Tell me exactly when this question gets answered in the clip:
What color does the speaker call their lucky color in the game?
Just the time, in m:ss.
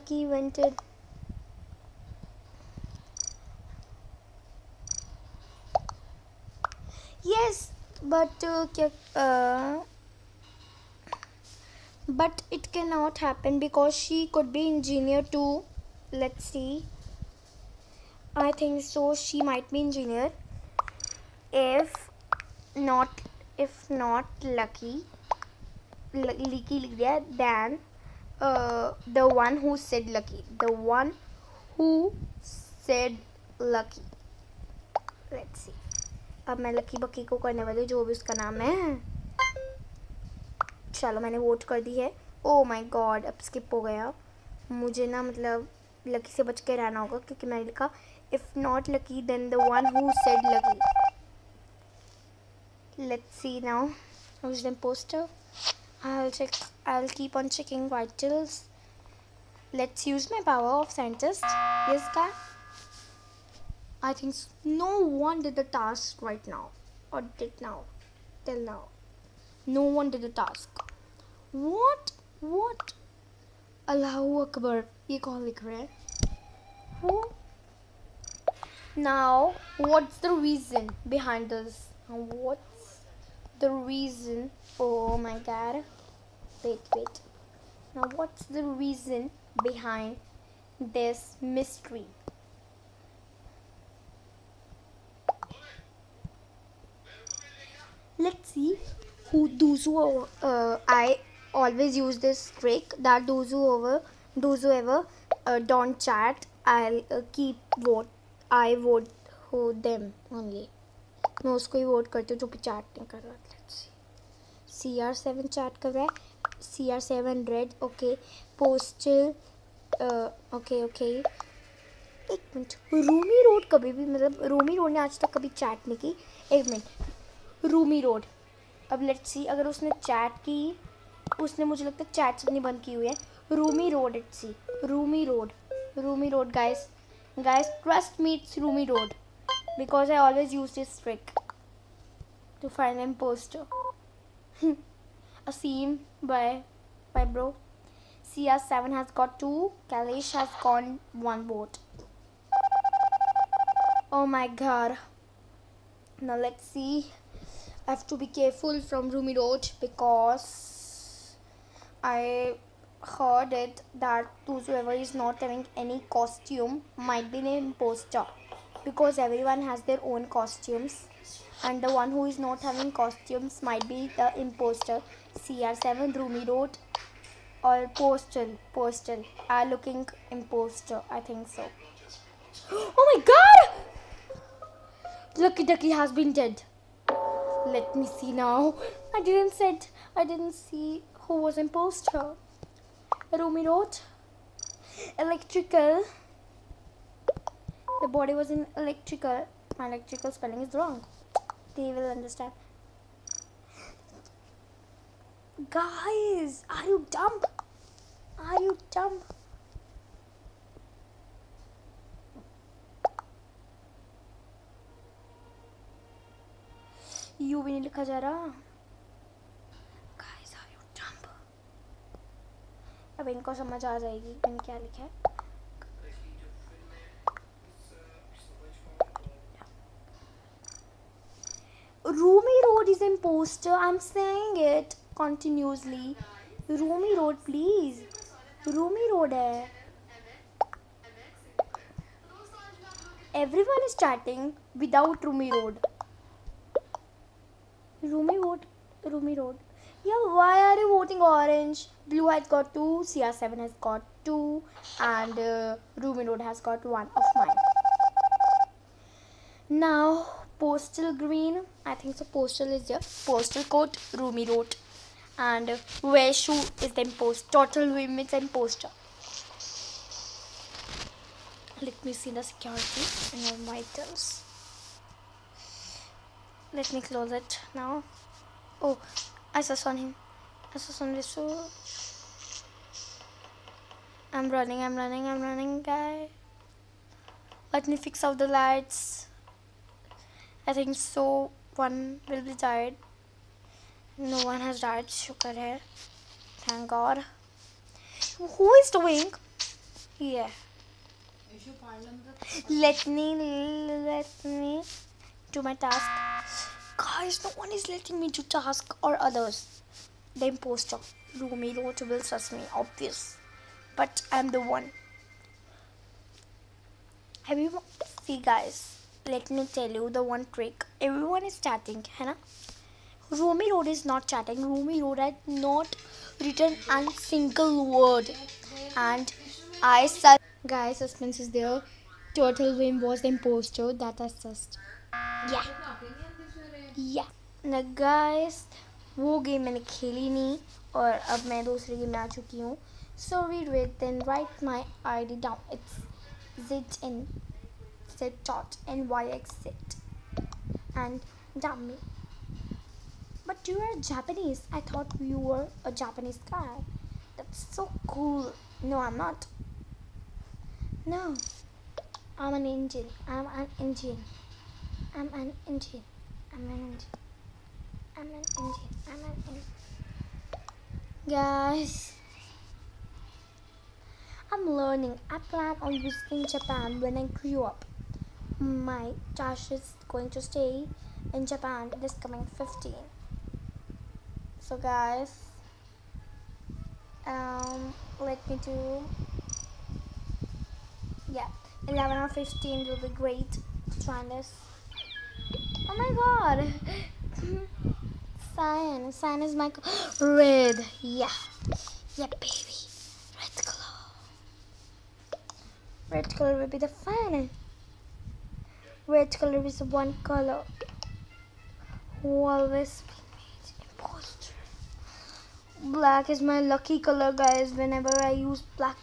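6:55.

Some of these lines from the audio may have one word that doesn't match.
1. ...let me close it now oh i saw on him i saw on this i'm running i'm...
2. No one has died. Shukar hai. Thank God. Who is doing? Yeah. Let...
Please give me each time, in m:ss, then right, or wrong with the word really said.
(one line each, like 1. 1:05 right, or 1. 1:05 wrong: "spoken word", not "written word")
1. 4:36 right
2. 4:54 right.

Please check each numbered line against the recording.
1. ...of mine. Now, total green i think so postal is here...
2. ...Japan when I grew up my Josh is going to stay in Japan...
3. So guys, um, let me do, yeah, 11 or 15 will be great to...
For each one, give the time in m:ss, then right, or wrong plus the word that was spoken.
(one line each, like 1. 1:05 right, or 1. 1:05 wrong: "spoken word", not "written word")
1. 4:17 wrong: "postal", not "total"
2. 6:16 right
3. 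6:24 right.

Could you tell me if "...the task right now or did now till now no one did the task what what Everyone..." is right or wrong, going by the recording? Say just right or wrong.
wrong.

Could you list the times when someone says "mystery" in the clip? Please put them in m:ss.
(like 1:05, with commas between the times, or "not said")
1:31.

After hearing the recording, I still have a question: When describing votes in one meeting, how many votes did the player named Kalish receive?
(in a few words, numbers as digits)
1.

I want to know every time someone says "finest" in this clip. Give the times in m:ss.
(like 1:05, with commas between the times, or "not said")
6:46.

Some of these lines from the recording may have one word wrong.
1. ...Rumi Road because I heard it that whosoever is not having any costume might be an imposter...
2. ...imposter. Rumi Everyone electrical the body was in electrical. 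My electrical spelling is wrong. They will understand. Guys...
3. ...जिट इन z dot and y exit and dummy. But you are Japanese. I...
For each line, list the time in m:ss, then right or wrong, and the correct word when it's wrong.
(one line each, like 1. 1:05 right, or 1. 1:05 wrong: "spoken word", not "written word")
1. 2:39 right
2. 3:11 wrong: "Road", not "Everyone"
3. 5:46 right.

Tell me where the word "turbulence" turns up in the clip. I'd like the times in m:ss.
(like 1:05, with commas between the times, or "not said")
not said.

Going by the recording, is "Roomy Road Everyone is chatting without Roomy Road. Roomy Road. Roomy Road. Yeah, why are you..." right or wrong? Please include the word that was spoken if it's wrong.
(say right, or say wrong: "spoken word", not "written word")
right.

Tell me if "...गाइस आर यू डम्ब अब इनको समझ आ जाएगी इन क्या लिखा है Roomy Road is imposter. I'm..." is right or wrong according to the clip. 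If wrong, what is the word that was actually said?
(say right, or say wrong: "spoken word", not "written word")
right.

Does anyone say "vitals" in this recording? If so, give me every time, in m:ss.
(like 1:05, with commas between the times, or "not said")
0:57, 4:33.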